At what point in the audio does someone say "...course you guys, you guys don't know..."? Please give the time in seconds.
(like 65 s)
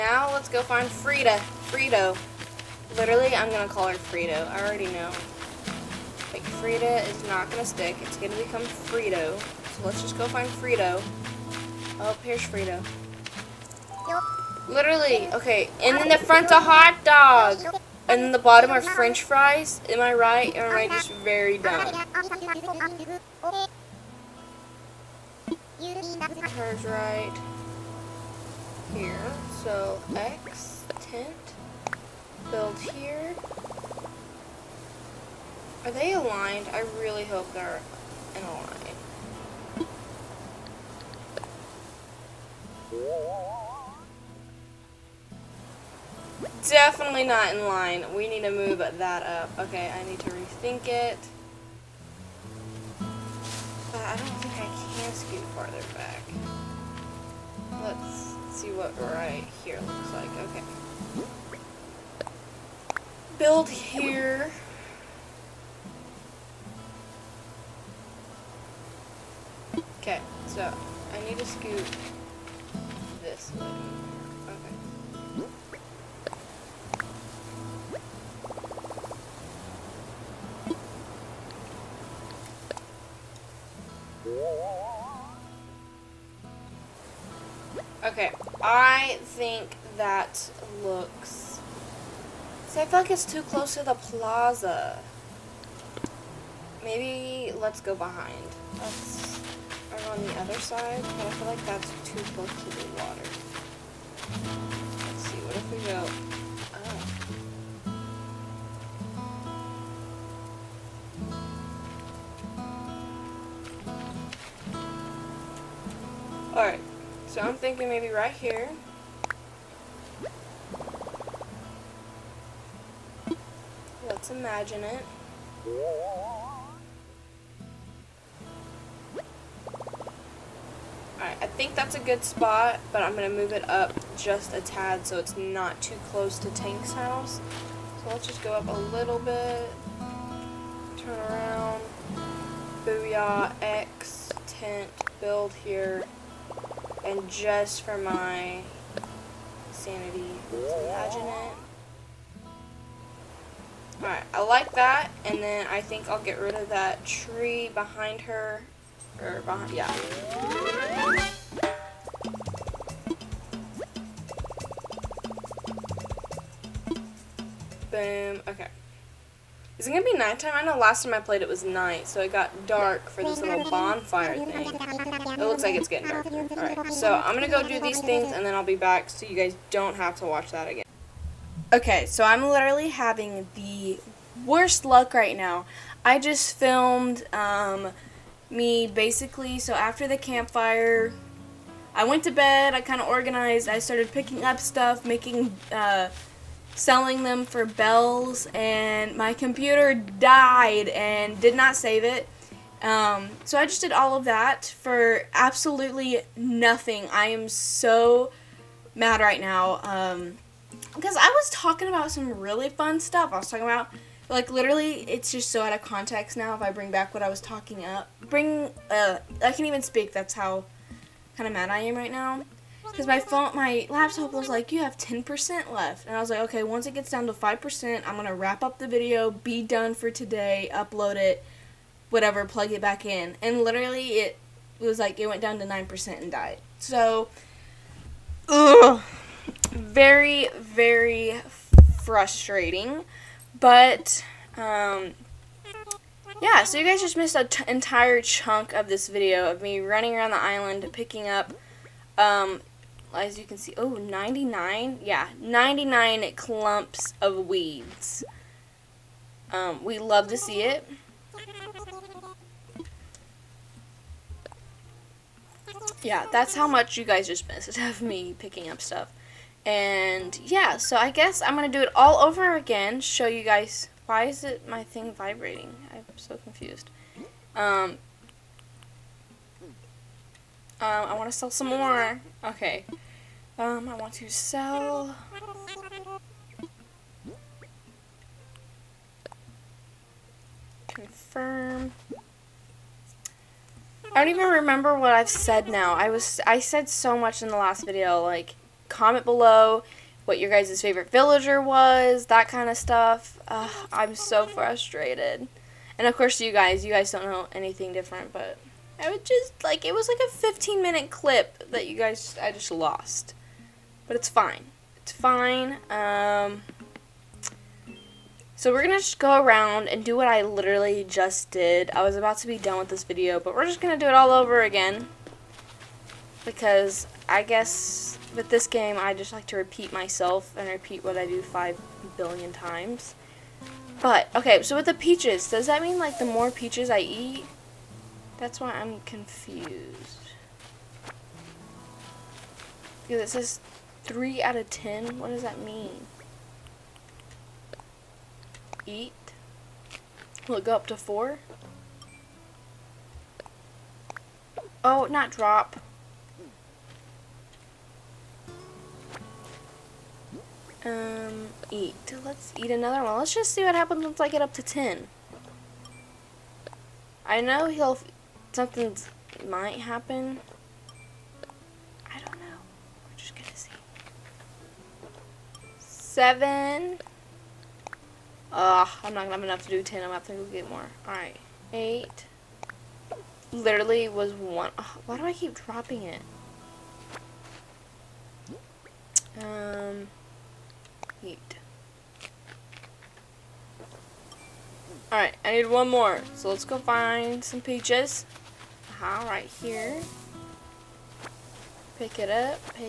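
306 s.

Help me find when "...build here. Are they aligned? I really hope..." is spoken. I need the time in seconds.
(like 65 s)
32 s.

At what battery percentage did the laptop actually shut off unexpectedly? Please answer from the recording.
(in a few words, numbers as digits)
9%.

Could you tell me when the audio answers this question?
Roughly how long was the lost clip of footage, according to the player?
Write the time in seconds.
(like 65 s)
310 s.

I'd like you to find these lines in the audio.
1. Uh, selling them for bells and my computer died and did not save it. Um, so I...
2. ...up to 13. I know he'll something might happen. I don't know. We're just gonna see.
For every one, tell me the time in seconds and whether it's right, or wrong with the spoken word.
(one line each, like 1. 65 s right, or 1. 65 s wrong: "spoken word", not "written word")
1. 195 s right
2. 364 s wrong: "10", not "13".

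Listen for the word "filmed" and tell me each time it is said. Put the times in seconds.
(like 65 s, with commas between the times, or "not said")
186 s.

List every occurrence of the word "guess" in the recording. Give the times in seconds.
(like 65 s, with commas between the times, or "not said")
271 s, 327 s.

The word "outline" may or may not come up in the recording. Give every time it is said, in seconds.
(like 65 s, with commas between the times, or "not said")
not said.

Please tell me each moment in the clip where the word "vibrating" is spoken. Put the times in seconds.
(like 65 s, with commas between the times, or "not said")
275 s.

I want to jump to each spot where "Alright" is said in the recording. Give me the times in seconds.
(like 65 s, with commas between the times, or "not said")
116 s, 131 s, 154 s, 176 s, 381 s, 395 s.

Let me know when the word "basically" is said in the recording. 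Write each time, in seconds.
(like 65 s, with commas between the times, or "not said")
188 s.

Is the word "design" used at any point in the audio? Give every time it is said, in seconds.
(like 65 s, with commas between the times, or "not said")
not said.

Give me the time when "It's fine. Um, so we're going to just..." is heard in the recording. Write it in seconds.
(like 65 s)
314 s.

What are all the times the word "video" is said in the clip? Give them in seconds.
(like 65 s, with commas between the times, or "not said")
228 s, 249 s, 297 s, 323 s.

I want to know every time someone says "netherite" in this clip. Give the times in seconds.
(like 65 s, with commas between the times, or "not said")
not said.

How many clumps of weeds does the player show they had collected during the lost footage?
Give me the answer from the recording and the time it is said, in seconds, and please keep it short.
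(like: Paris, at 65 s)
99, at 255 s.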